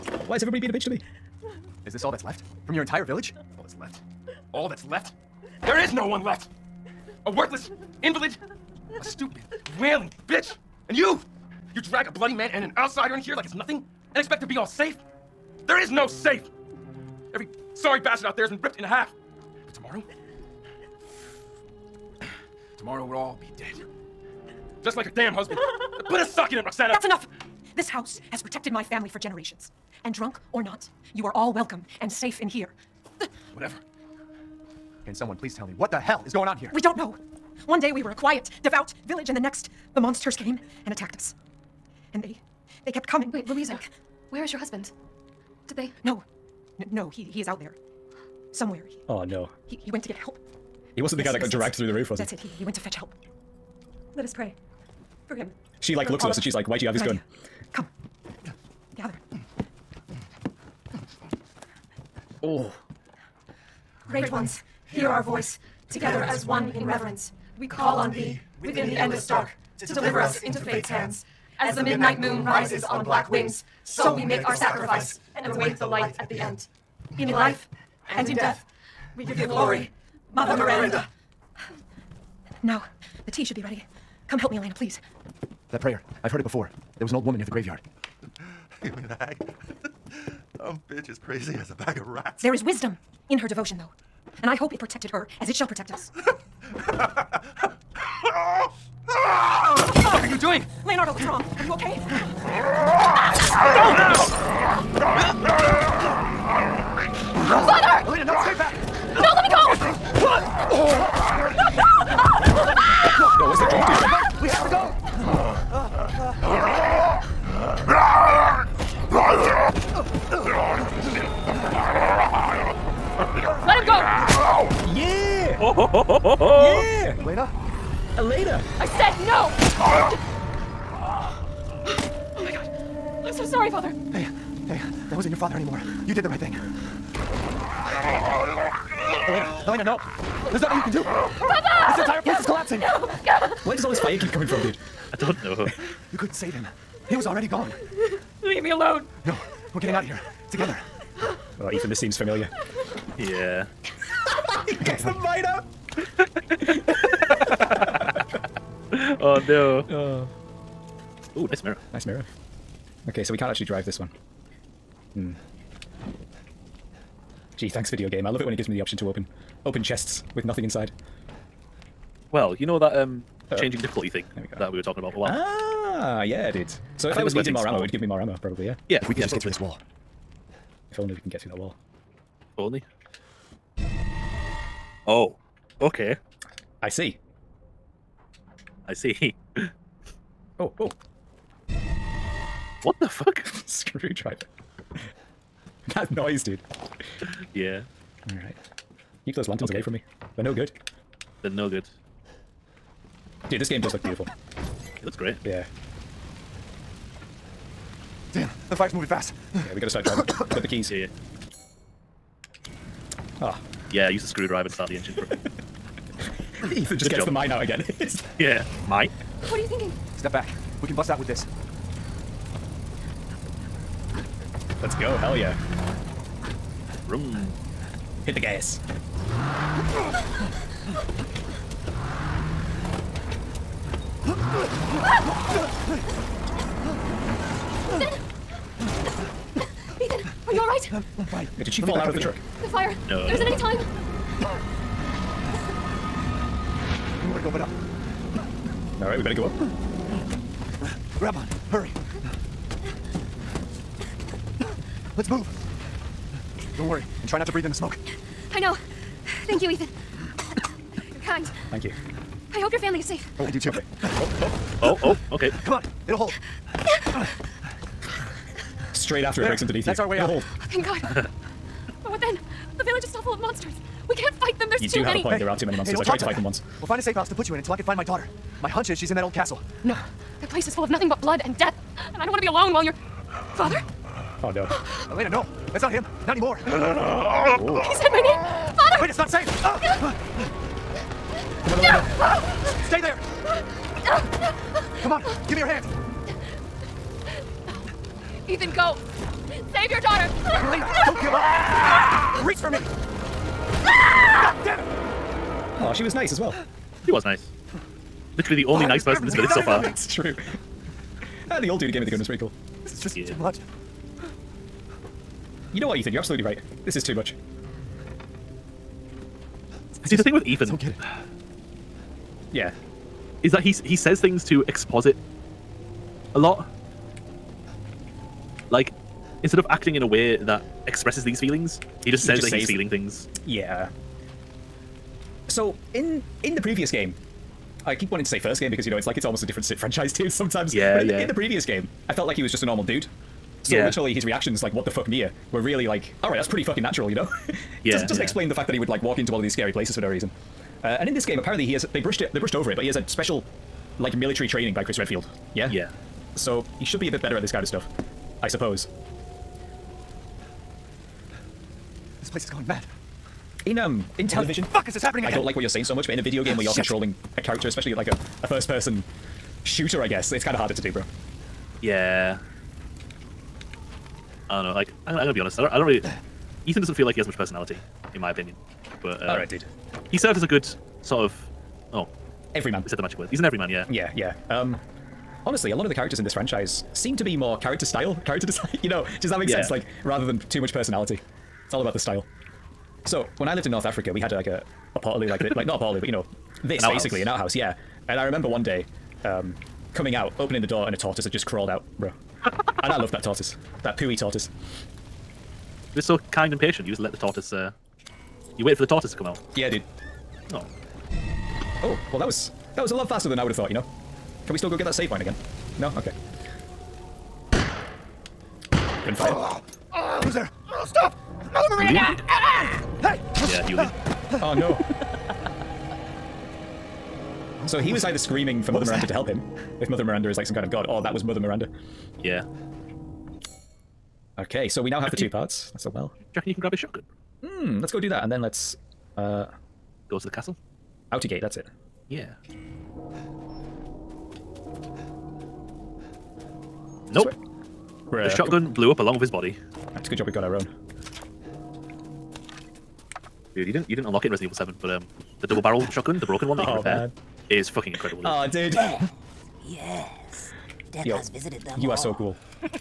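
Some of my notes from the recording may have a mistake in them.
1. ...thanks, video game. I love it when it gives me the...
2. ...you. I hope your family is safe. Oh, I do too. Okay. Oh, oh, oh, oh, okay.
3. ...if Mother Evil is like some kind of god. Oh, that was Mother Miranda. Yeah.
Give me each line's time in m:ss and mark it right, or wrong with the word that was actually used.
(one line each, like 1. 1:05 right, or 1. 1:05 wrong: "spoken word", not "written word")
1. 2:47 right
2. 4:21 right
3. 7:09 wrong: "Miranda", not "Evil".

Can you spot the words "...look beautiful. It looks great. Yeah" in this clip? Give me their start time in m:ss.
3:23.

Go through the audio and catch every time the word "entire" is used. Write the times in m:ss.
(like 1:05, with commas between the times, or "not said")
0:02, 2:22.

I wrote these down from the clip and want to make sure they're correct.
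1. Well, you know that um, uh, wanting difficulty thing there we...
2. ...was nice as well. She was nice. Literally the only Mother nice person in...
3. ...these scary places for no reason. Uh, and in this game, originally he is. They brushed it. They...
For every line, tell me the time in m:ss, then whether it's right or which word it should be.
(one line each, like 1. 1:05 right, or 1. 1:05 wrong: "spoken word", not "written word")
1. 2:52 wrong: "changing", not "wanting"
2. 5:06 wrong: "Why", not "Mother"
3. 5:49 wrong: "apparently", not "originally".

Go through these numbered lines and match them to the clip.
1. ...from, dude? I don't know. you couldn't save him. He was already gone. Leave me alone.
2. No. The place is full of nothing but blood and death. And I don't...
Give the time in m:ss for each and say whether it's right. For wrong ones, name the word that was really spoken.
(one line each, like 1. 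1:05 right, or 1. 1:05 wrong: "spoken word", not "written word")
1. 2:24 right
2. 4:39 right.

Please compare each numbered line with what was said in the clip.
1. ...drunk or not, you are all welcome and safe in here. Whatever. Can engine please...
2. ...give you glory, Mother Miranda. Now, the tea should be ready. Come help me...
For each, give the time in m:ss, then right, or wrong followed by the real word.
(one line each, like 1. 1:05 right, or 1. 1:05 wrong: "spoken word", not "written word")
1. 0:30 wrong: "someone", not "engine"
2. 1:19 right.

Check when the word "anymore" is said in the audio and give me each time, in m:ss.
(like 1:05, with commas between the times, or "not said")
2:15, 4:46.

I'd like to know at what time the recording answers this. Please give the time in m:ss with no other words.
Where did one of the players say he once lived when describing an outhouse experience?
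6:33.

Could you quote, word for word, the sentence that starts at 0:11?
You drag a bloody man and an outsider in here like it's nothing?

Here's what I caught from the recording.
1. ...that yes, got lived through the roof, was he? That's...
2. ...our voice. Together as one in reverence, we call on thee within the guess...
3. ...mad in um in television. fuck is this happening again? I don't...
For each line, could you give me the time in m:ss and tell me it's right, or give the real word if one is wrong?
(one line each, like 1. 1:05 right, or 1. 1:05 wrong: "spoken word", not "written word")
1. 0:51 wrong: "dragged", not "lived"
2. 1:05 wrong: "endless", not "guess"
3. 6:02 right.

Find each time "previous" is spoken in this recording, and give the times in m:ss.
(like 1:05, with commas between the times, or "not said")
5:36, 5:41.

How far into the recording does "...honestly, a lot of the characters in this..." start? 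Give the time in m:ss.
6:25.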